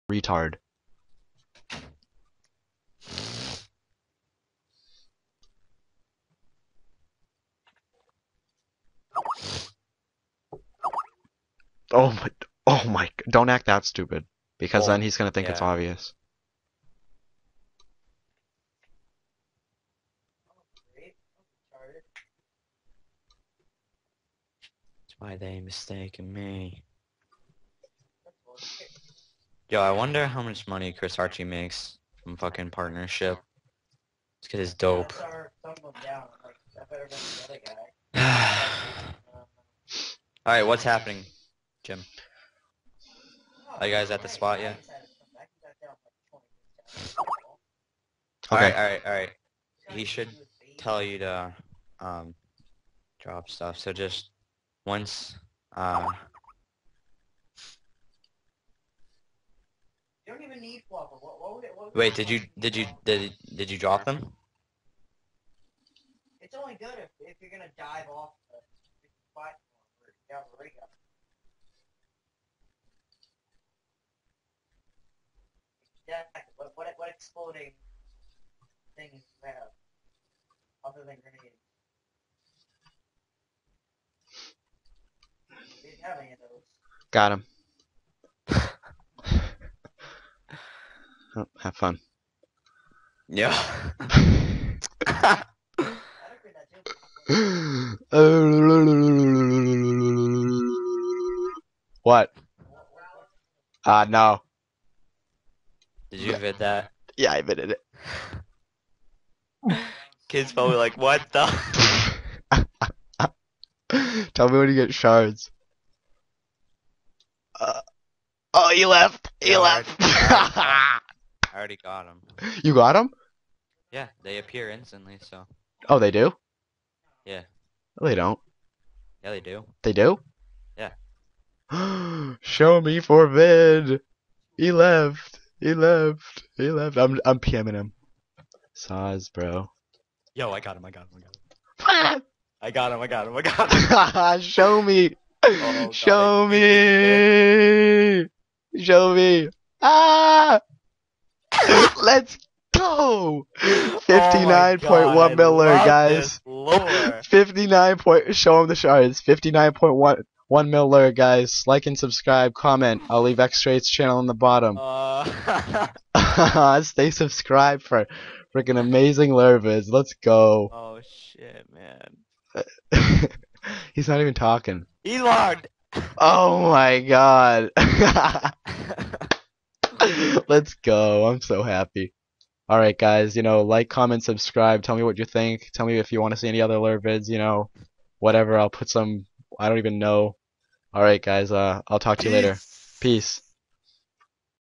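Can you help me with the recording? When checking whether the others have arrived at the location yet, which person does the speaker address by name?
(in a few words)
Jim.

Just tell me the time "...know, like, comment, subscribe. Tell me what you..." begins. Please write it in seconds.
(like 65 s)
183 s.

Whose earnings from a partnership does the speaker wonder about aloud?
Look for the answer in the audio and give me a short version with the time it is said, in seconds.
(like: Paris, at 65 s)
Chris Archie, at 30 s.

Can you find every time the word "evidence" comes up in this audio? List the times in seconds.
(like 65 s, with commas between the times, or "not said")
not said.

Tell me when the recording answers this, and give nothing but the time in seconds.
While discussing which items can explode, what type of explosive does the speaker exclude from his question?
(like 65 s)
81 s.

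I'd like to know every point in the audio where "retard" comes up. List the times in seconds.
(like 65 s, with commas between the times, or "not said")
0 s.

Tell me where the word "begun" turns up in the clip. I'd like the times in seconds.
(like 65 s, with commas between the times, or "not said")
not said.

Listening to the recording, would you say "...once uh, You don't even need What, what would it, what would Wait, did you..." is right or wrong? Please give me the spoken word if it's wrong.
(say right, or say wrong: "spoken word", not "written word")
right.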